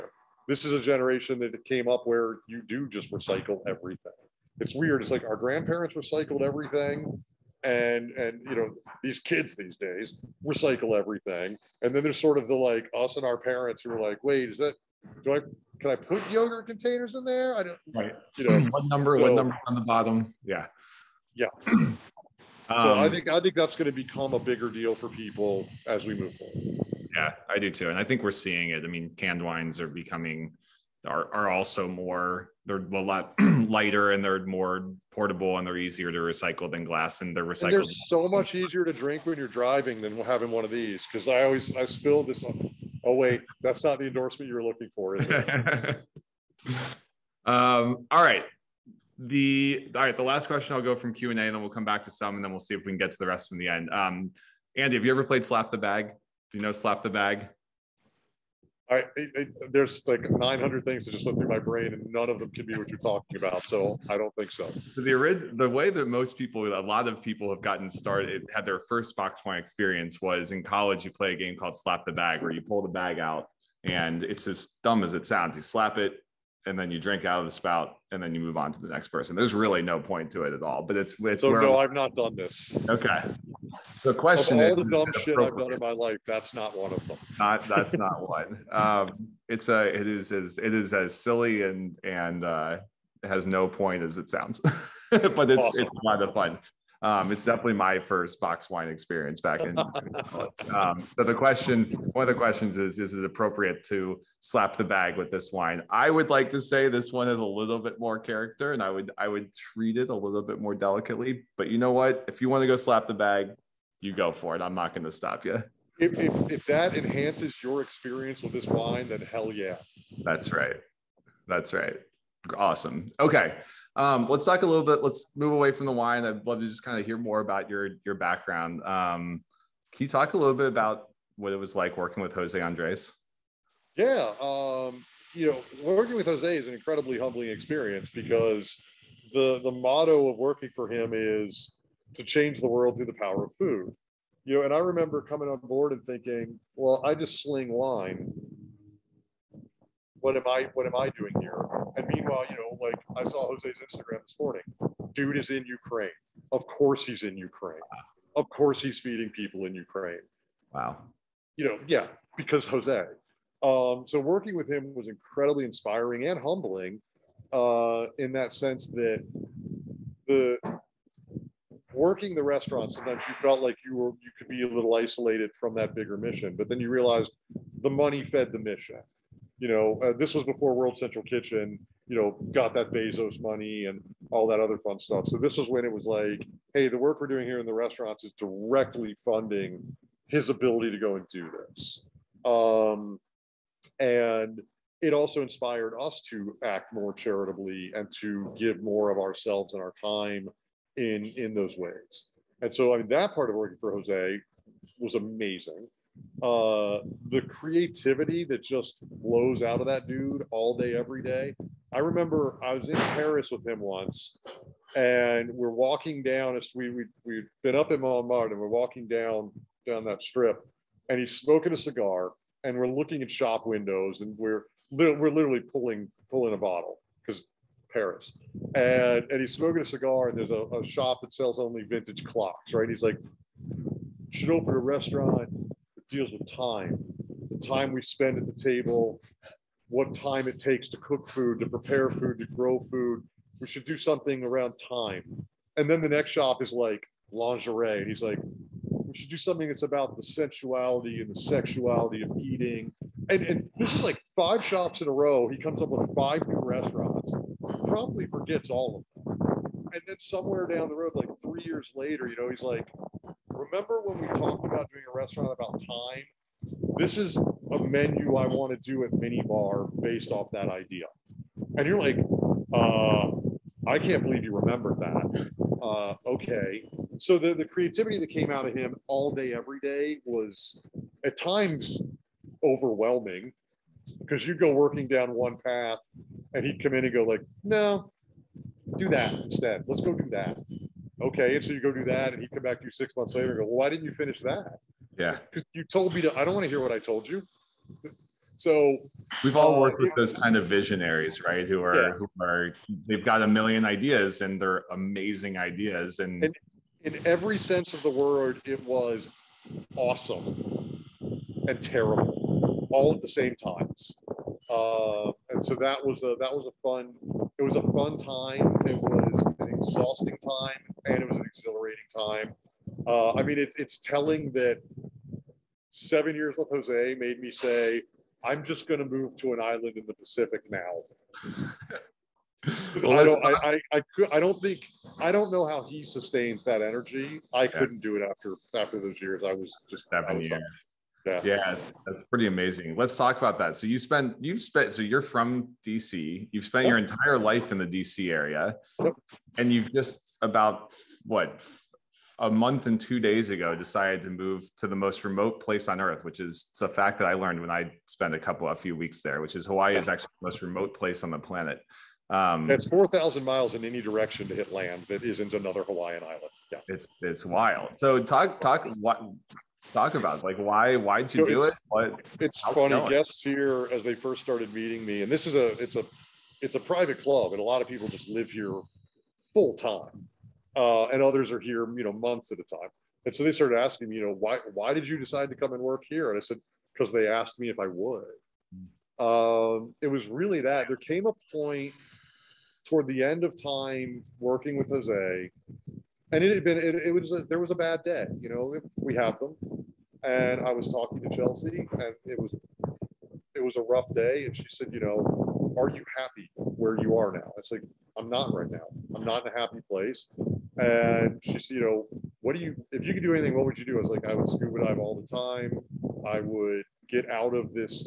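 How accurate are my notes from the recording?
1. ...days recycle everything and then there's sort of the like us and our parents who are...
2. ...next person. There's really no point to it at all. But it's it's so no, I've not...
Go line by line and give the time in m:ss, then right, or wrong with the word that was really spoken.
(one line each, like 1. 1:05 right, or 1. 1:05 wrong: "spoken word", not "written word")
1. 0:09 right
2. 1:18 right.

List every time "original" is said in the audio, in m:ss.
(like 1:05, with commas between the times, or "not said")
1:05.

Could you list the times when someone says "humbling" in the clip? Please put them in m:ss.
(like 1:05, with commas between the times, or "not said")
2:17, 2:46.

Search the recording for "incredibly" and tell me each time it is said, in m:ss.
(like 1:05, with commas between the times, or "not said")
2:16, 2:45.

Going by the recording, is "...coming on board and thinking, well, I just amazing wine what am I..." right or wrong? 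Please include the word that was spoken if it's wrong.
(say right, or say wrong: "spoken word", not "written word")
wrong: "sling", not "amazing".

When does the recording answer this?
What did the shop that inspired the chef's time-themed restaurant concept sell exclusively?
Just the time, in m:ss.
3:51.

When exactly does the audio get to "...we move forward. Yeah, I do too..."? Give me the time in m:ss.
0:26.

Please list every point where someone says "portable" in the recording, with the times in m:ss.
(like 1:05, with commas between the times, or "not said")
0:35.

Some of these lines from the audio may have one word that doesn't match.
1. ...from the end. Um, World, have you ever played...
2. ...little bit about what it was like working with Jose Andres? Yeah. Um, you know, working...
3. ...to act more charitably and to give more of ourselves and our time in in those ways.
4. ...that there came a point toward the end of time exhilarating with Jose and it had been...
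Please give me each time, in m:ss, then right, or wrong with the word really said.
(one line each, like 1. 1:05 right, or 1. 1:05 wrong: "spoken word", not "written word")
1. 0:53 wrong: "Andy", not "World"
2. 2:10 right
3. 3:16 right
4. 6:30 wrong: "working", not "exhilarating".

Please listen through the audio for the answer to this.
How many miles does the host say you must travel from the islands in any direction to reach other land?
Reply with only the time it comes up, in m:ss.
6:02.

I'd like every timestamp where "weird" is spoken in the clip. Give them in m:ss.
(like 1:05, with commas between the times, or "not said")
0:04.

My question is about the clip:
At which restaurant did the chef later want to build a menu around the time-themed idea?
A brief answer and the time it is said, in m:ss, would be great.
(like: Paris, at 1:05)
minibar, at 4:29.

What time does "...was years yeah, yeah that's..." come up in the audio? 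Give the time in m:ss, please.
5:40.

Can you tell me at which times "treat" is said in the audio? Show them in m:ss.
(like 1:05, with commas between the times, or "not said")
1:49.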